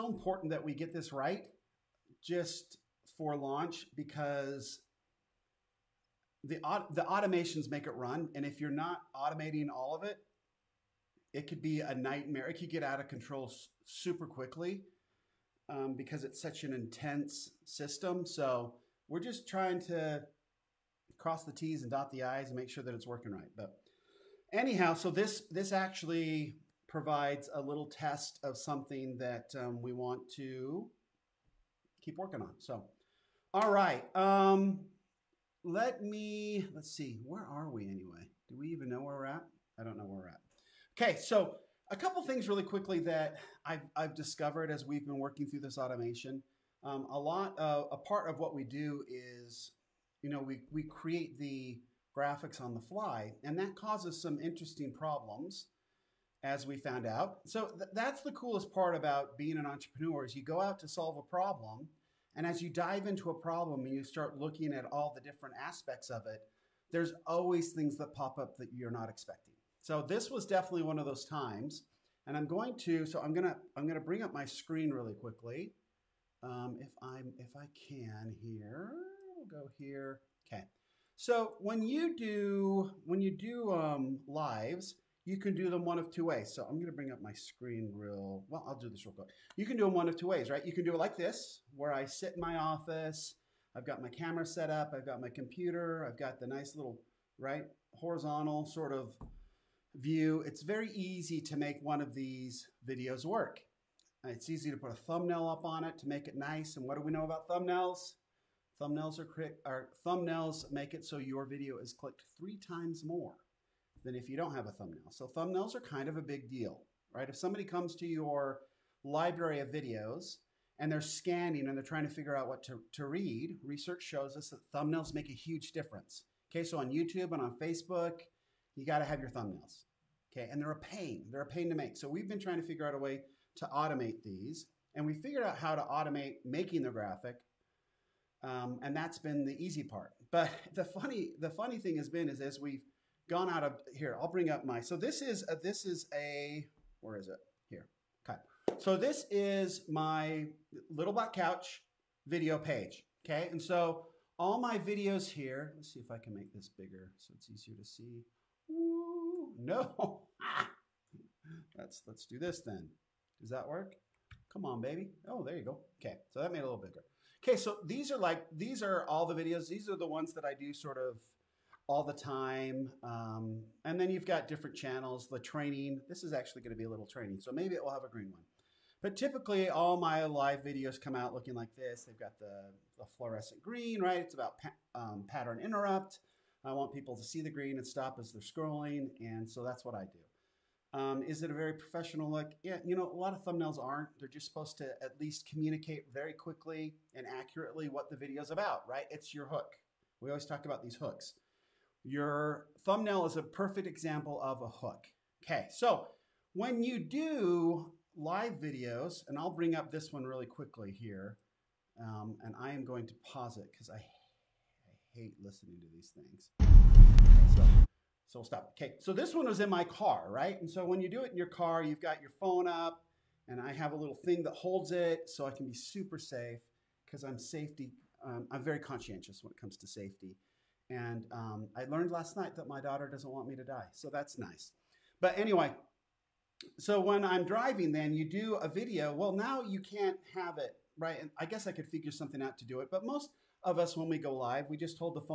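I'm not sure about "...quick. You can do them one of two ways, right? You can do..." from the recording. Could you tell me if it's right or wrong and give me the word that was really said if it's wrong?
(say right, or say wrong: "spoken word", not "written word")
right.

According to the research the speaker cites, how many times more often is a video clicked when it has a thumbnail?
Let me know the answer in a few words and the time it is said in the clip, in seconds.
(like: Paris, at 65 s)
3 times, at 112 s.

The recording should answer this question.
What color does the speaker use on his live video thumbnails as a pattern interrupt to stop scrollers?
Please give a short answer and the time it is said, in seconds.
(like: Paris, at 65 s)
Fluorescent green, at 183 s.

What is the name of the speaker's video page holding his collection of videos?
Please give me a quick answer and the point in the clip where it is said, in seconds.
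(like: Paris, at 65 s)
Black Couch, at 151 s.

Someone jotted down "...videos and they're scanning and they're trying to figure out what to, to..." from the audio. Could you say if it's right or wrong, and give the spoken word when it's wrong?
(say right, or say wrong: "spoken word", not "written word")
right.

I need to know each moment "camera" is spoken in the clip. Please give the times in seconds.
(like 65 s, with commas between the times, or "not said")
94 s.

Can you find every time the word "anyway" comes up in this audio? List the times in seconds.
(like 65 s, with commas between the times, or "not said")
37 s, 235 s.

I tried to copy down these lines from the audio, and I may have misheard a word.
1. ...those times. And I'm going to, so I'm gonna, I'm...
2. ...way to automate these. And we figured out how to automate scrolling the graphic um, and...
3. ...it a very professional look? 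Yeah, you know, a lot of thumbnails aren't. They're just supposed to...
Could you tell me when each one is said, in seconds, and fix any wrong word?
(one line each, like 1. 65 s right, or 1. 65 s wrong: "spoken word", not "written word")
1. 71 s right
2. 132 s wrong: "making", not "scrolling"
3. 191 s right.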